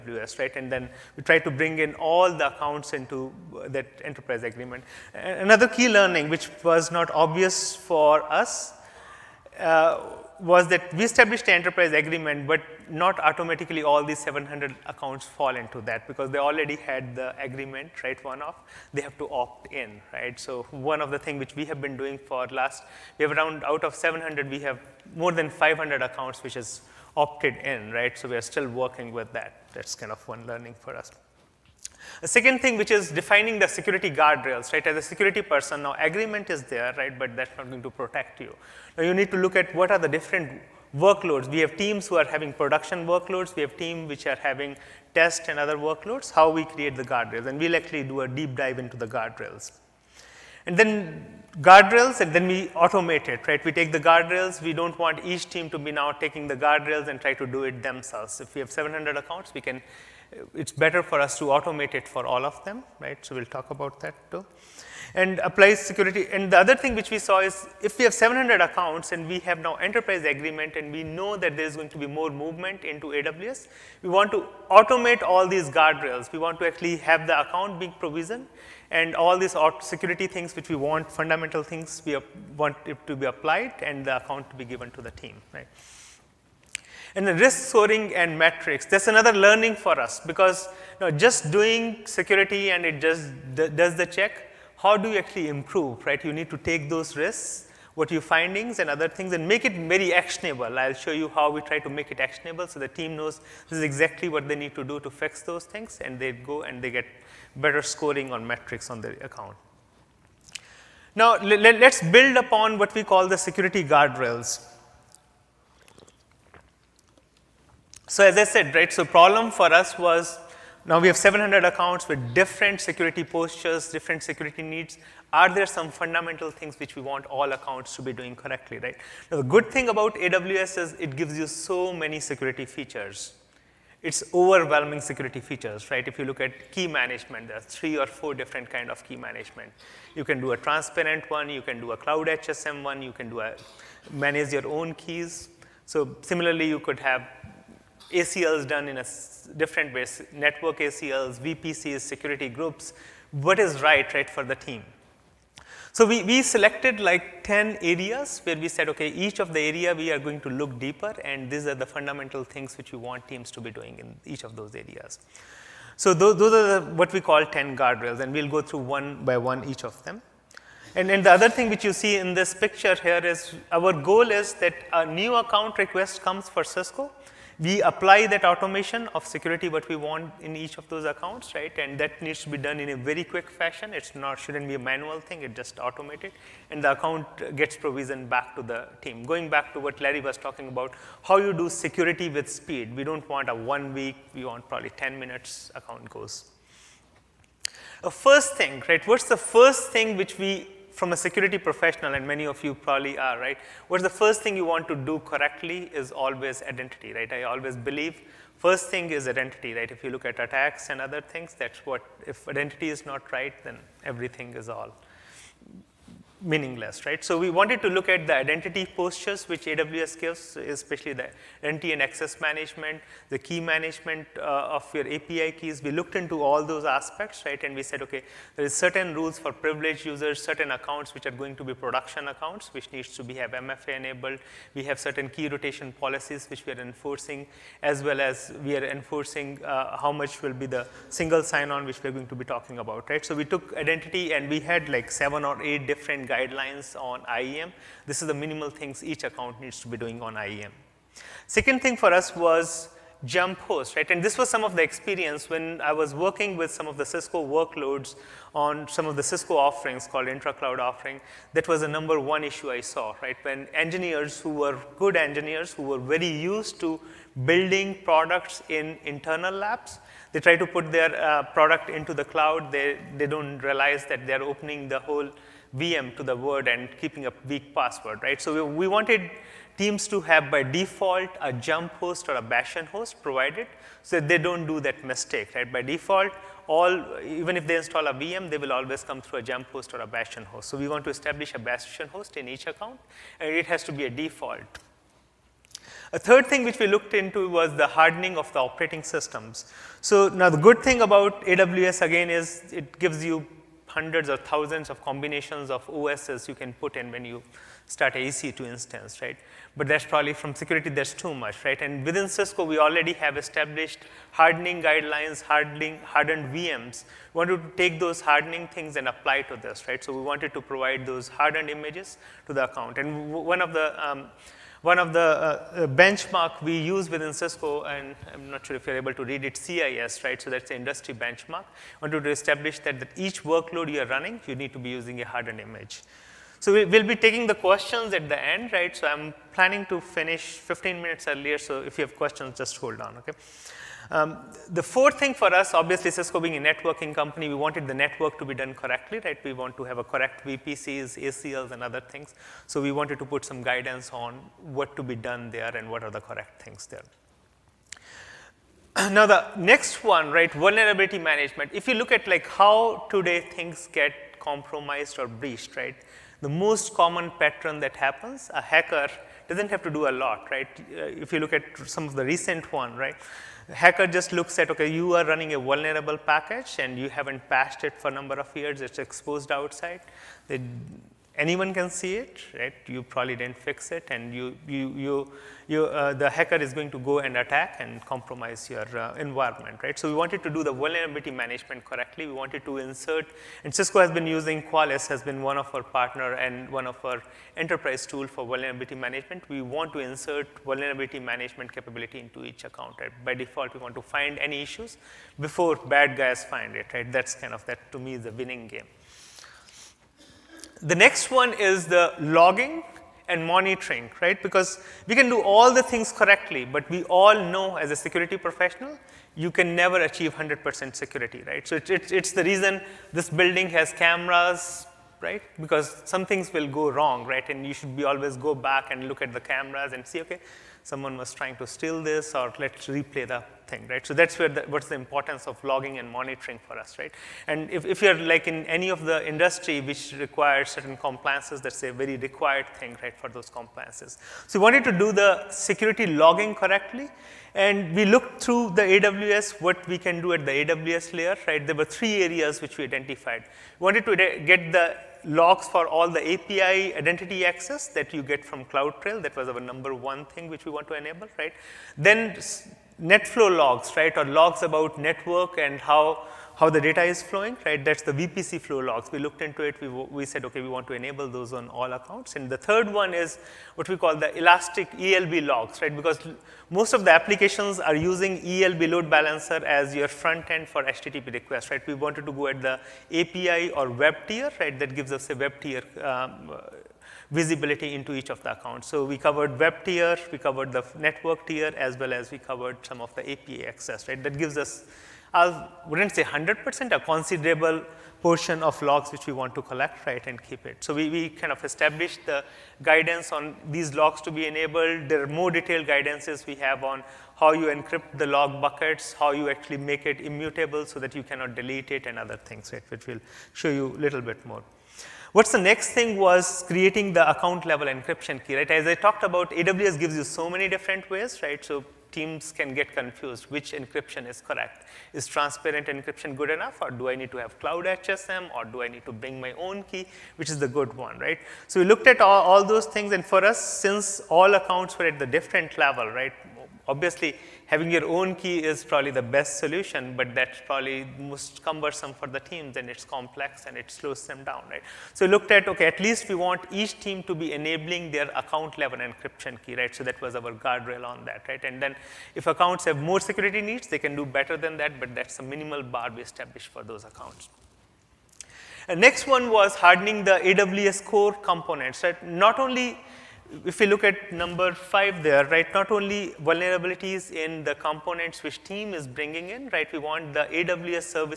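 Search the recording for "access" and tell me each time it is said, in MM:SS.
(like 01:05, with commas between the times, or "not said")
03:42, 07:37, 08:13.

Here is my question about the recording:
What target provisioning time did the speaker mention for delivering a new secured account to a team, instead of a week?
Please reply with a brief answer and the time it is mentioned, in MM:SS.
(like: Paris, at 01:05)
10 minutes, at 03:14.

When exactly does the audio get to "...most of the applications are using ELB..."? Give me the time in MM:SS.
07:56.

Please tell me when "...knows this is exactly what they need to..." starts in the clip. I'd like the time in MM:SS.
01:43.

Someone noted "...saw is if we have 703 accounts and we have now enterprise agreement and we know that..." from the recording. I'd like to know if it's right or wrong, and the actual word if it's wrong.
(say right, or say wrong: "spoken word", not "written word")
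wrong: "700", not "703".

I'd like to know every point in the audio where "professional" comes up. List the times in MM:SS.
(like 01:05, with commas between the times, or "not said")
03:21, 06:58.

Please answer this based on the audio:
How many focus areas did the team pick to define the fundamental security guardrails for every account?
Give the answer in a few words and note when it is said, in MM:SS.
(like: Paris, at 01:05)
10, at 02:36.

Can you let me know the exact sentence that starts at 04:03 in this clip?
So we took identity and we had like seven or eight different guidelines on IAM.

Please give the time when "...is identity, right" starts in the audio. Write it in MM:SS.
03:29.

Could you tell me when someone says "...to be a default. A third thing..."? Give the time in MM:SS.
04:53.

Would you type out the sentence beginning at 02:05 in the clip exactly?
Are there some fundamental things which we want all accounts to be doing correctly, right?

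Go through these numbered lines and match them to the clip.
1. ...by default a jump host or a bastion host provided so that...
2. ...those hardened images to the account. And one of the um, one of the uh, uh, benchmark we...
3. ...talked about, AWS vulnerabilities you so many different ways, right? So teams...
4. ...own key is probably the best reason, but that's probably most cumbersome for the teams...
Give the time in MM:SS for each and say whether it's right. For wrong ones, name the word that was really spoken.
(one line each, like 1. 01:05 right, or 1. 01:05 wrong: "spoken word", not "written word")
1. 04:40 right
2. 05:21 right
3. 08:38 wrong: "gives", not "vulnerabilities"
4. 08:58 wrong: "solution", not "reason".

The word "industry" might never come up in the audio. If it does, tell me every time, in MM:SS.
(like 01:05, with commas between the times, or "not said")
05:30, 07:19.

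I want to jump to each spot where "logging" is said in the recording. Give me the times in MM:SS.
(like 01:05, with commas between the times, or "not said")
06:52, 07:15, 07:26.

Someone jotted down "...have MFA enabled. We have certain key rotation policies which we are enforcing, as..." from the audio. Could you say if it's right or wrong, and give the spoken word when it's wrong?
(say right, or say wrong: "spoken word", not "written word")
right.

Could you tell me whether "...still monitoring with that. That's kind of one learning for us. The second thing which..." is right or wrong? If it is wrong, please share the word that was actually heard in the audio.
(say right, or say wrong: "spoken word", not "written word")
wrong: "working", not "monitoring".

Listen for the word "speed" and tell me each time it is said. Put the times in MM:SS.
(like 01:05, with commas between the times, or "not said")
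03:12.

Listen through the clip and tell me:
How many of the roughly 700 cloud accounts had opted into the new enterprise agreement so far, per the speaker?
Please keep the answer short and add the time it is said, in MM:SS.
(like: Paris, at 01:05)
more than 500, at 00:25.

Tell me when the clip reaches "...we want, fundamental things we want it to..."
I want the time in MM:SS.
01:20.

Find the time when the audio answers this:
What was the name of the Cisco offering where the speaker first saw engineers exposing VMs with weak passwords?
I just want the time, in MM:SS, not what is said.
04:20.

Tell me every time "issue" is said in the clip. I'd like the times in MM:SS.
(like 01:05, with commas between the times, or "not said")
04:22, 06:44.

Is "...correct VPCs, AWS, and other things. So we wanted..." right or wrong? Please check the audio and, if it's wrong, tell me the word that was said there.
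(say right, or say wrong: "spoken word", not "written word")
wrong: "ACLs", not "AWS".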